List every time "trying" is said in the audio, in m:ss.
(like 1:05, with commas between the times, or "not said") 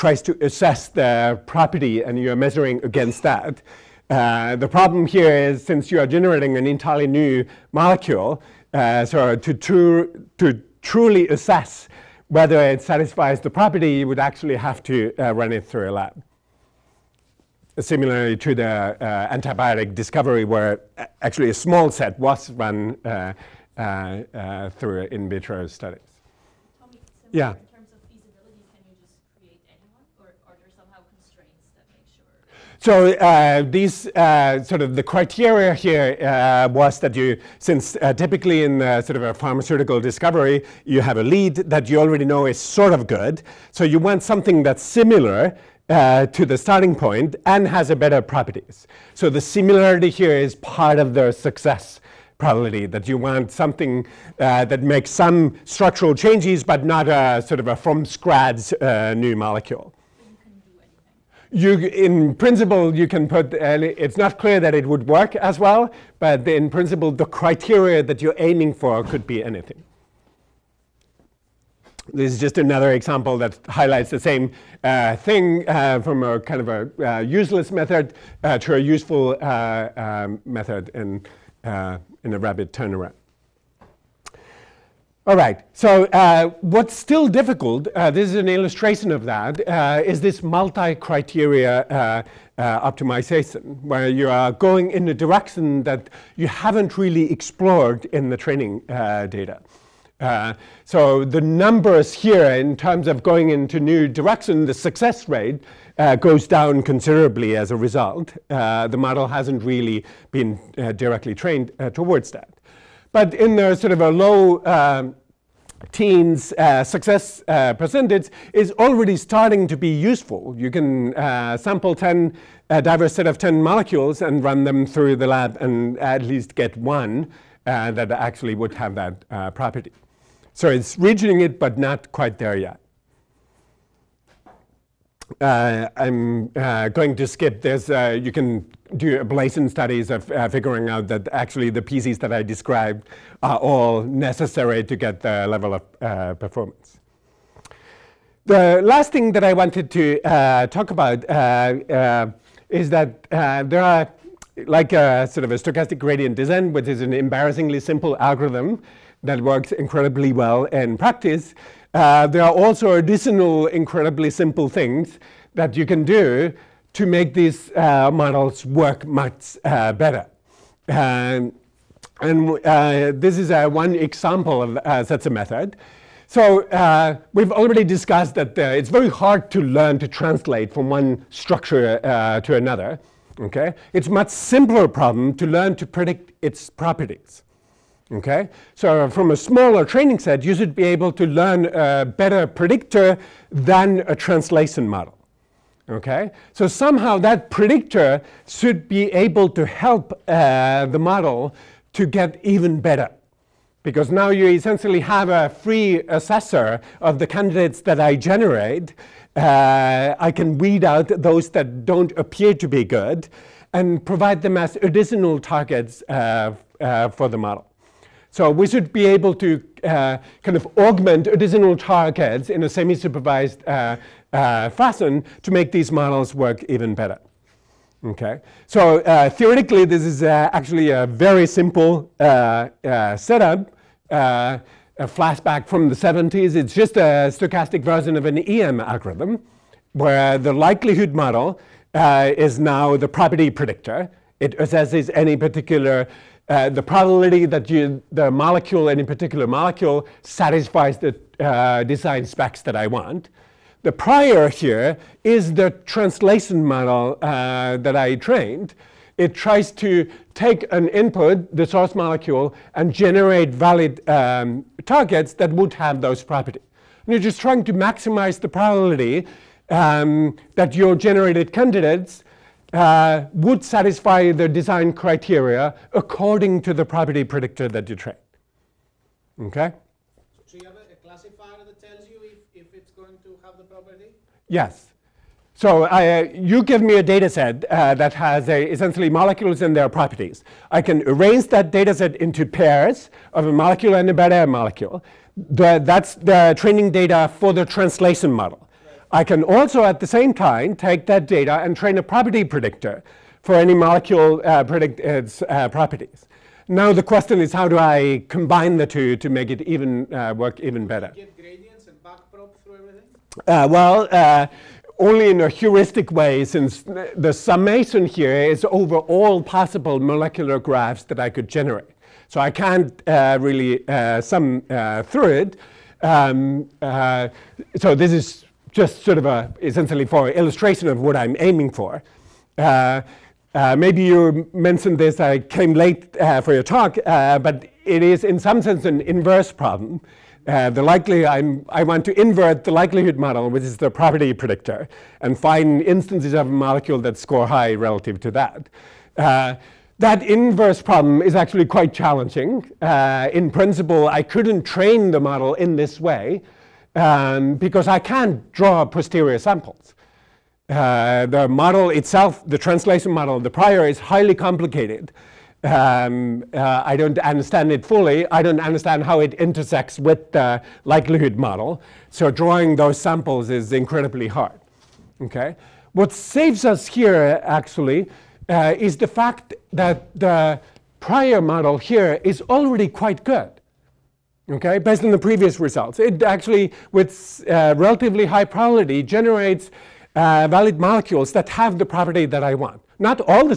4:27.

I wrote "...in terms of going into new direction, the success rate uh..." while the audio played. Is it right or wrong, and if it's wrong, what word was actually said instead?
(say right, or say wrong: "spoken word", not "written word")
right.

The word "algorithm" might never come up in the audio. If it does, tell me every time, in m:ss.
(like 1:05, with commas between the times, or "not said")
2:38, 3:58.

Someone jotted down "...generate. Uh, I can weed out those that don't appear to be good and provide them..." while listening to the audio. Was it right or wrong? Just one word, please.
right.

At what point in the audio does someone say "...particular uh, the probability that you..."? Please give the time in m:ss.
4:05.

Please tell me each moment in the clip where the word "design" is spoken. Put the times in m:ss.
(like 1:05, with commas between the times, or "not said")
4:11, 4:34.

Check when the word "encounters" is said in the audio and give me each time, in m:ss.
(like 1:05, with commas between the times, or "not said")
not said.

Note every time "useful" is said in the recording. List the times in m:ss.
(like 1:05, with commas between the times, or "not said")
1:18, 1:59.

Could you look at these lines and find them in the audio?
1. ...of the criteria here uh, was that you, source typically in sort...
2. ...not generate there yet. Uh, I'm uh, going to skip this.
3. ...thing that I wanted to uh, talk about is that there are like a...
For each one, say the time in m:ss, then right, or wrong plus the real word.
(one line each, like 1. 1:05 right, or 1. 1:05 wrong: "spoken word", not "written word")
1. 0:34 wrong: "since", not "source"
2. 2:11 wrong: "quite", not "generate"
3. 2:29 right.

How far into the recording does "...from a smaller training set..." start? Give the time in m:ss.
3:09.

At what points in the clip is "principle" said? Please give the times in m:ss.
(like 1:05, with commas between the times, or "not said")
1:02, 1:06, 5:53.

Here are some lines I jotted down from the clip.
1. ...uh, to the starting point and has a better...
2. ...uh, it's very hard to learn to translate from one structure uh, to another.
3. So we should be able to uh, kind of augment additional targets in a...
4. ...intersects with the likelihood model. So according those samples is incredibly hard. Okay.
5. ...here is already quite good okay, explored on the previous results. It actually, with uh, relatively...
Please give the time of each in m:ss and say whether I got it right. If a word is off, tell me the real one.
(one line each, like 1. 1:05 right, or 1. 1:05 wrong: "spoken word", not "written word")
1. 0:45 right
2. 2:58 right
3. 3:38 right
4. 6:09 wrong: "drawing", not "according"
5. 6:21 wrong: "based", not "explored".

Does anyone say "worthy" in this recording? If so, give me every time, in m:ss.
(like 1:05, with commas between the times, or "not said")
not said.